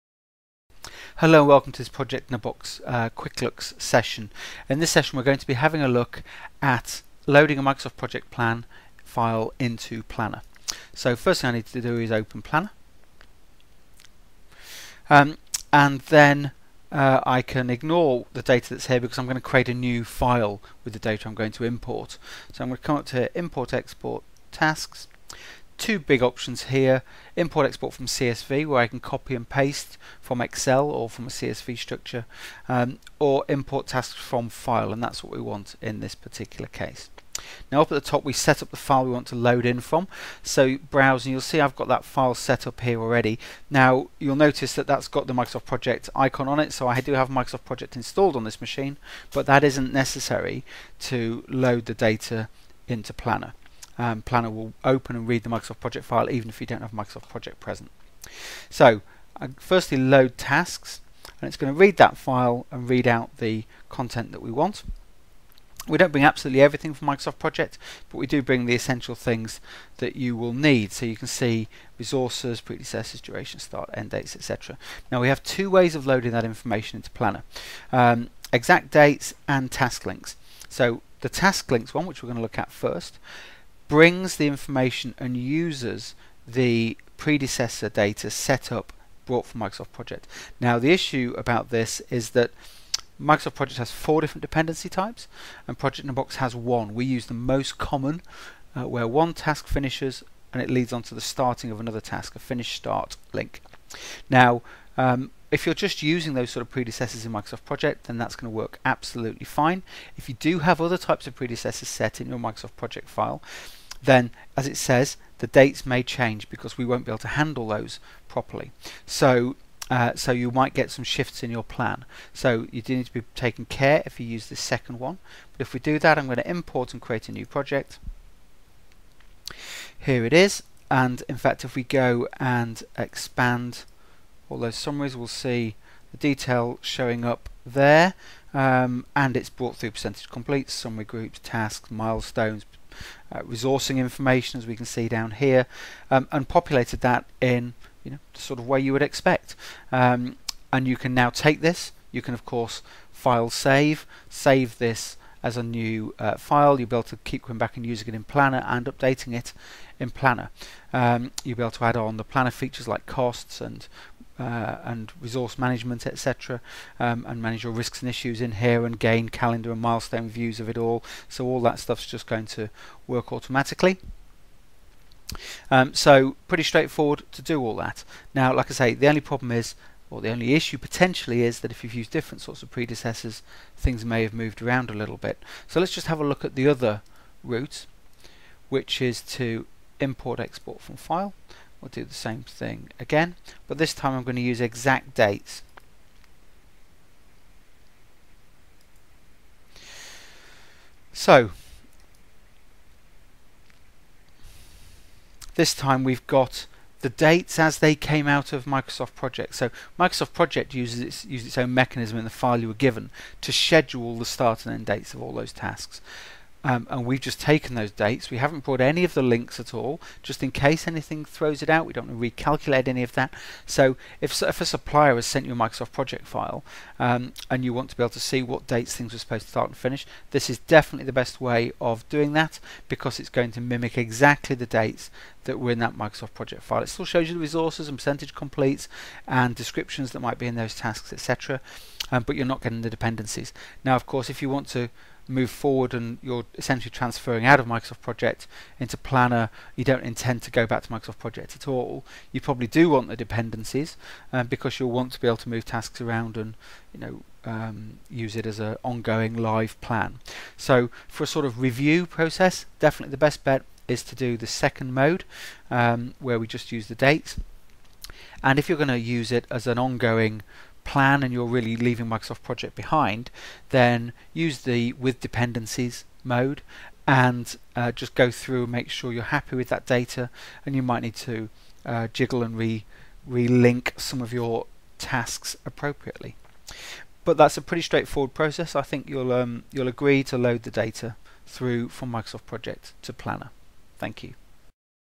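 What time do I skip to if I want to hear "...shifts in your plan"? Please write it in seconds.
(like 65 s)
121 s.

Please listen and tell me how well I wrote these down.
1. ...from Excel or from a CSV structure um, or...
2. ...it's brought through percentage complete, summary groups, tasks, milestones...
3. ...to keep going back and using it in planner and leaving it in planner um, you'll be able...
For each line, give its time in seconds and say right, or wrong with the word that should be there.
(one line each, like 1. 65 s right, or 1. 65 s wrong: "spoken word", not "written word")
1. 30 s right
2. 139 s right
3. 157 s wrong: "updating", not "leaving".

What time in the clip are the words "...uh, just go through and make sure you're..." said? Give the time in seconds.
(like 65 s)
277 s.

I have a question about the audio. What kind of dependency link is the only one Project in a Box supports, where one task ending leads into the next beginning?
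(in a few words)
finish start link.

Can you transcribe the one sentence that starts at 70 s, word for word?
So you can see resources, predecessors, duration, start, end dates, etc.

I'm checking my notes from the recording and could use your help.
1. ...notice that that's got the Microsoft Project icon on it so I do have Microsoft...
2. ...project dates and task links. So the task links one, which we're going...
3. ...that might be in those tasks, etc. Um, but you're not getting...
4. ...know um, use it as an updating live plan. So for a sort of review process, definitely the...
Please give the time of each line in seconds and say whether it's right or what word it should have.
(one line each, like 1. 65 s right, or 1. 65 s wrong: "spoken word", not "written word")
1. 44 s right
2. 78 s wrong: "exact", not "project"
3. 240 s right
4. 256 s wrong: "ongoing", not "updating".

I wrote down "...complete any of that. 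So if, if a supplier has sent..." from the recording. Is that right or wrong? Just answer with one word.
wrong.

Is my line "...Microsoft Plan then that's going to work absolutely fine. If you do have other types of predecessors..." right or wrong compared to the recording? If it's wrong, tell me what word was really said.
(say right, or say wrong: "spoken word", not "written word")
wrong: "Project", not "Plan".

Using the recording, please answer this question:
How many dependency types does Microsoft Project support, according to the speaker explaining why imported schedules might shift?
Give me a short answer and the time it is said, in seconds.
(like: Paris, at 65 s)
4, at 93 s.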